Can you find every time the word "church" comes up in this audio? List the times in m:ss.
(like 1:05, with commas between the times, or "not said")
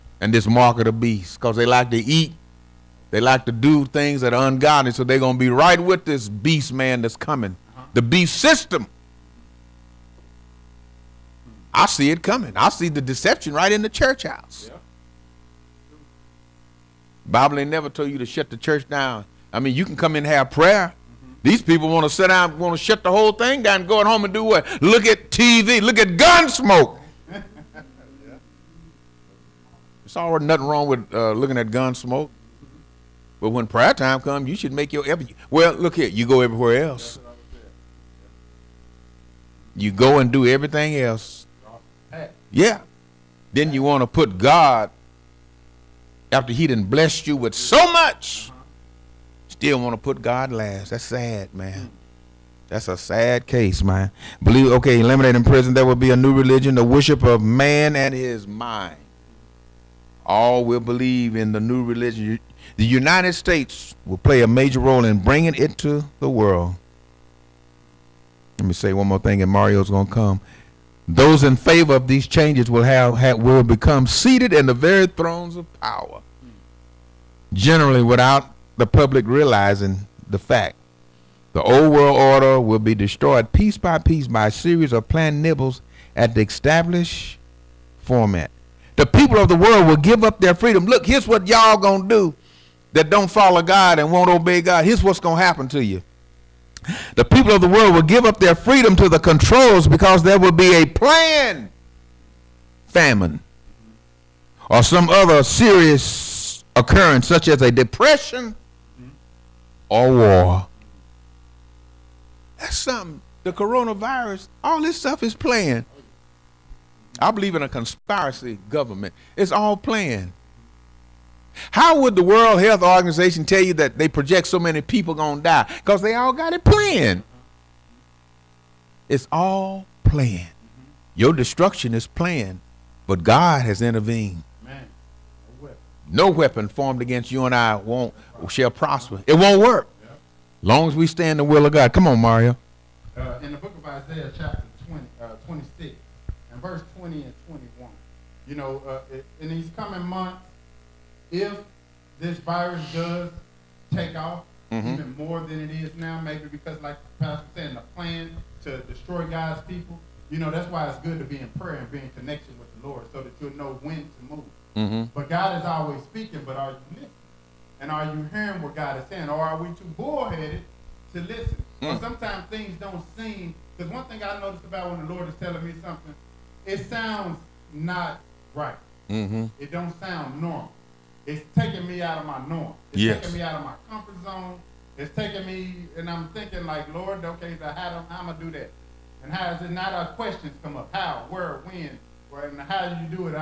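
0:13, 0:18.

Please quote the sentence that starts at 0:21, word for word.
These people want to sit down, want to shut the whole thing down, go at home and do what?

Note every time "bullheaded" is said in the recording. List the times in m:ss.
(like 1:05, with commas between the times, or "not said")
2:49.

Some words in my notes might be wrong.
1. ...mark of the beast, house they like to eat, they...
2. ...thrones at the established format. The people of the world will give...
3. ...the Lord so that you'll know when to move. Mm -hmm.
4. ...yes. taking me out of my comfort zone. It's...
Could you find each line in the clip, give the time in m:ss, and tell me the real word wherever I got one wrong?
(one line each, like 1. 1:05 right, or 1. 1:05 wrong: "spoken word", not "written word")
1. 0:00 wrong: "cause", not "house"
2. 1:25 wrong: "nibbles", not "thrones"
3. 2:42 right
4. 3:03 right.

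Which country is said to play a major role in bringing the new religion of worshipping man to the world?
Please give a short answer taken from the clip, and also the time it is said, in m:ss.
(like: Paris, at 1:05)
The United States, at 1:02.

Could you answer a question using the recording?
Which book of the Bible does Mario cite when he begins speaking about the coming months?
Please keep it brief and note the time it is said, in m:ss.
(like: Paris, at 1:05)
Isaiah, at 2:23.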